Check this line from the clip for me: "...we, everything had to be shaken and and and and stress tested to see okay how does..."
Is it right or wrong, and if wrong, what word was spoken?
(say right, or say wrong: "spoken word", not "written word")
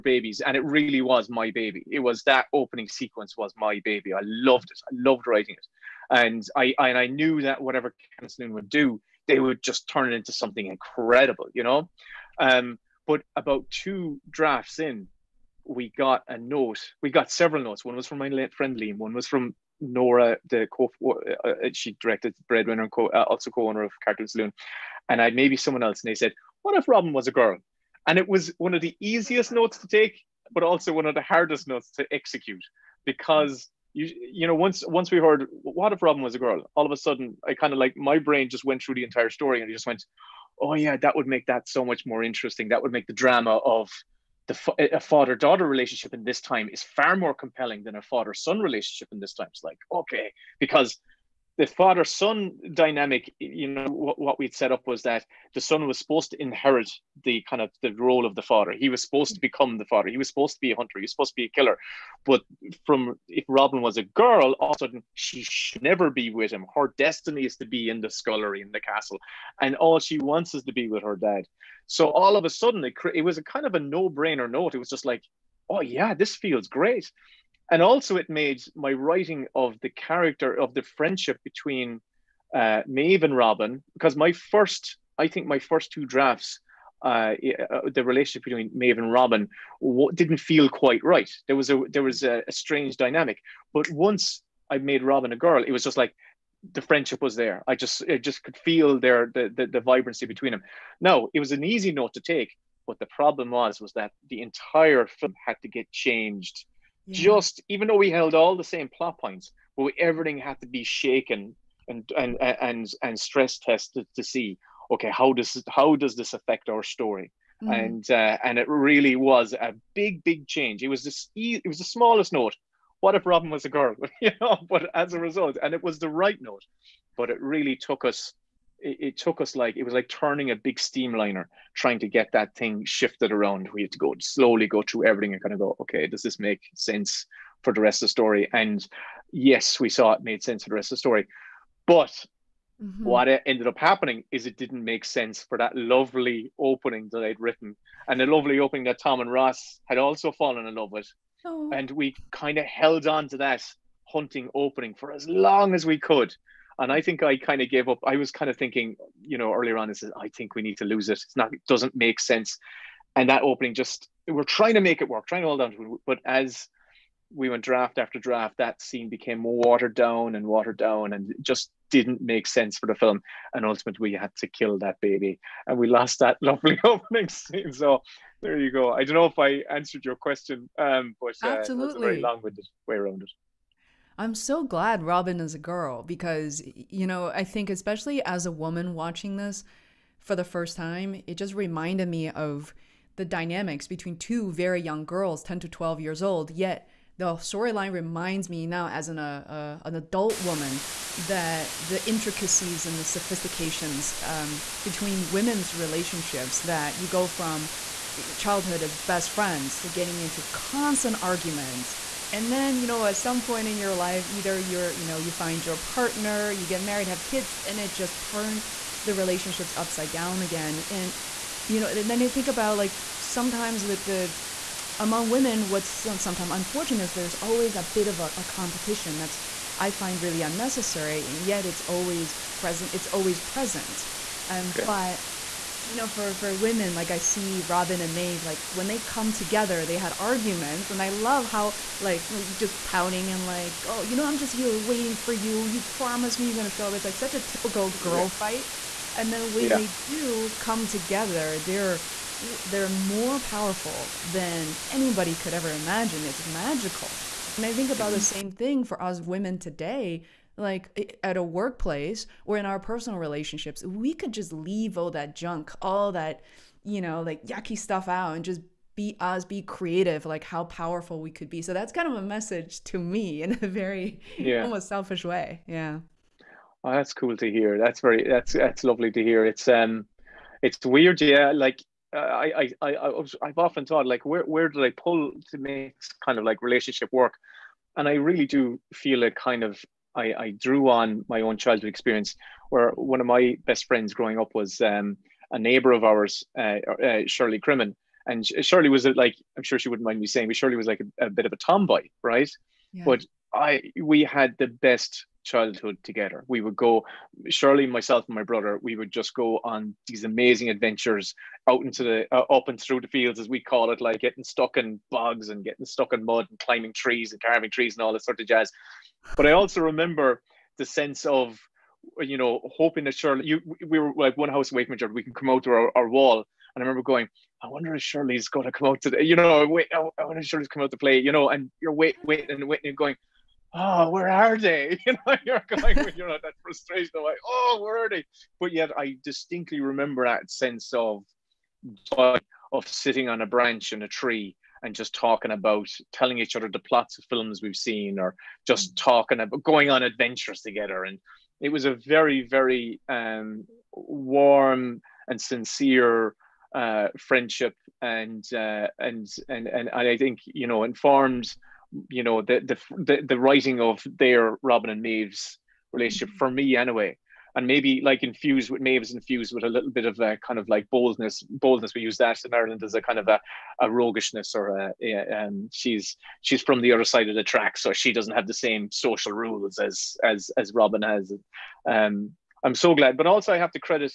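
right.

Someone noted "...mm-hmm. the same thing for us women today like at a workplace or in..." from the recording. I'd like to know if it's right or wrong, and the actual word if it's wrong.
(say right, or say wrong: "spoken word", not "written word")
right.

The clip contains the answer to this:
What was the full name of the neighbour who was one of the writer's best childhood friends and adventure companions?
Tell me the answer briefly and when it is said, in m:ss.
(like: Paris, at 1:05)
Shirley Crimmin, at 4:57.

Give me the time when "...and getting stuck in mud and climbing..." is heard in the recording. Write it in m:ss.
5:15.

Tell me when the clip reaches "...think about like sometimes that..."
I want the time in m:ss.
3:42.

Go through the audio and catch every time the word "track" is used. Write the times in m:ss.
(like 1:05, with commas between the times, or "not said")
6:17.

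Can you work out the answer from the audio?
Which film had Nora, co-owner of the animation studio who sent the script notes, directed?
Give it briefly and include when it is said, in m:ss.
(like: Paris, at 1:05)
Breadwinner, at 0:22.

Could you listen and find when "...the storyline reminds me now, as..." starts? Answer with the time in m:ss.
3:17.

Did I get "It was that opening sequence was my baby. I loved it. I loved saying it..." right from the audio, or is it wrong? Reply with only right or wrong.
wrong.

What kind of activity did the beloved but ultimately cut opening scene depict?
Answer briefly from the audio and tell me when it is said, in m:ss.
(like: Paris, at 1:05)
hunting, at 2:34.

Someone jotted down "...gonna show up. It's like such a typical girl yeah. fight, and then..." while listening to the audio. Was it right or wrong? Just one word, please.
right.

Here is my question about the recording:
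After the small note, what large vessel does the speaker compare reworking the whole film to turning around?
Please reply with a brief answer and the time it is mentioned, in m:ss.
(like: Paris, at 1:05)
steamliner, at 2:10.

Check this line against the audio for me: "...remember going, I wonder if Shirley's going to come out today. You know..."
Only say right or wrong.
right.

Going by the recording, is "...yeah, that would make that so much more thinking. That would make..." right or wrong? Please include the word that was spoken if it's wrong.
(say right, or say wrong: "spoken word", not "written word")
wrong: "interesting", not "thinking".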